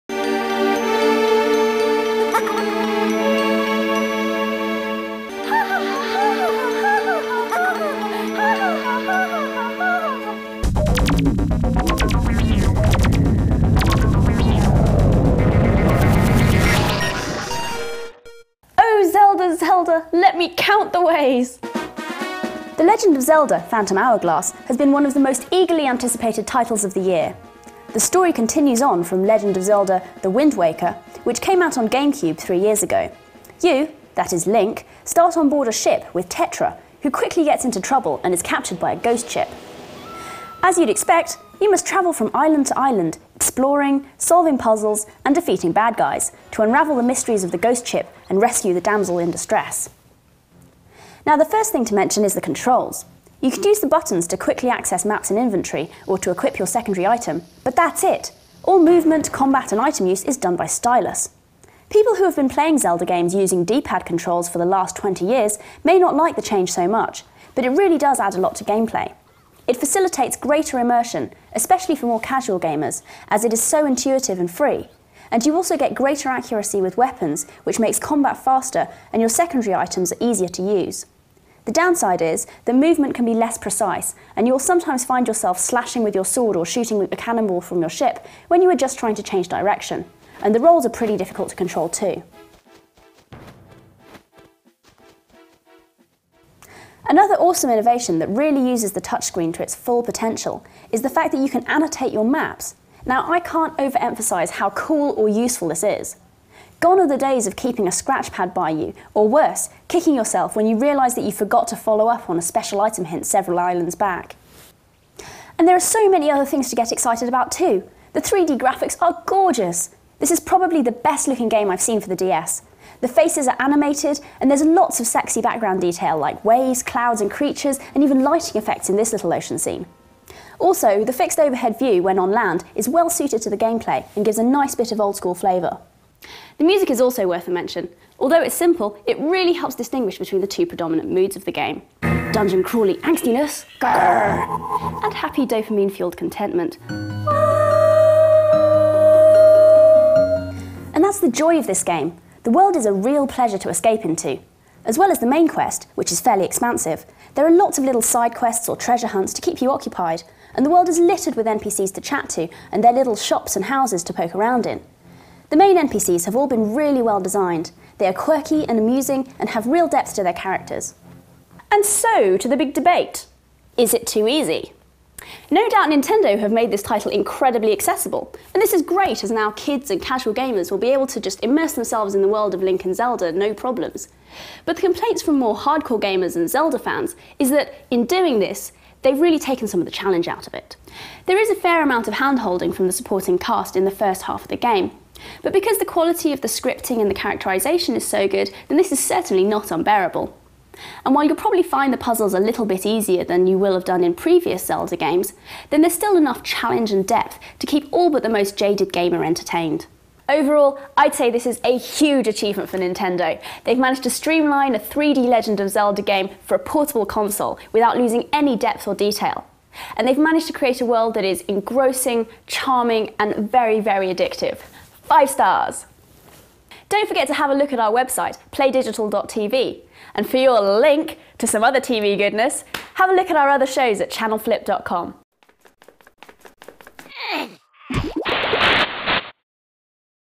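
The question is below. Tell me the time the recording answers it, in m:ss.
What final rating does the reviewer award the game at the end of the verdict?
3:45.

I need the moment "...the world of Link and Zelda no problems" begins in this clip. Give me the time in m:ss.
3:02.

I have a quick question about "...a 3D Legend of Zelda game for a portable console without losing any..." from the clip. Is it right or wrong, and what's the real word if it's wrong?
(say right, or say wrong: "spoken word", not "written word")
right.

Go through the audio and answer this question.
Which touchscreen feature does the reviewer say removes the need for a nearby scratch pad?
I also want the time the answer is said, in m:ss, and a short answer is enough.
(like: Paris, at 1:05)
Annotate your maps, at 1:41.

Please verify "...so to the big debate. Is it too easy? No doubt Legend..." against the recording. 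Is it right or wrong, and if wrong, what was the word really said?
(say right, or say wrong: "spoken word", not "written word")
wrong: "Nintendo", not "Legend".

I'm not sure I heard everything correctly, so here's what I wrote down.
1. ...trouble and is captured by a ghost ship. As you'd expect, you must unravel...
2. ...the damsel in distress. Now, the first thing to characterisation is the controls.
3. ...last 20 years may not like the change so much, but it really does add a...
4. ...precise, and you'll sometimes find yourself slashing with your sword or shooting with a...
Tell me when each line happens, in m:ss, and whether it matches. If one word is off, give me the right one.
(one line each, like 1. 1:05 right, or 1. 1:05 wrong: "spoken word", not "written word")
1. 0:37 wrong: "travel", not "unravel"
2. 0:48 wrong: "mention", not "characterisation"
3. 1:04 right
4. 1:23 right.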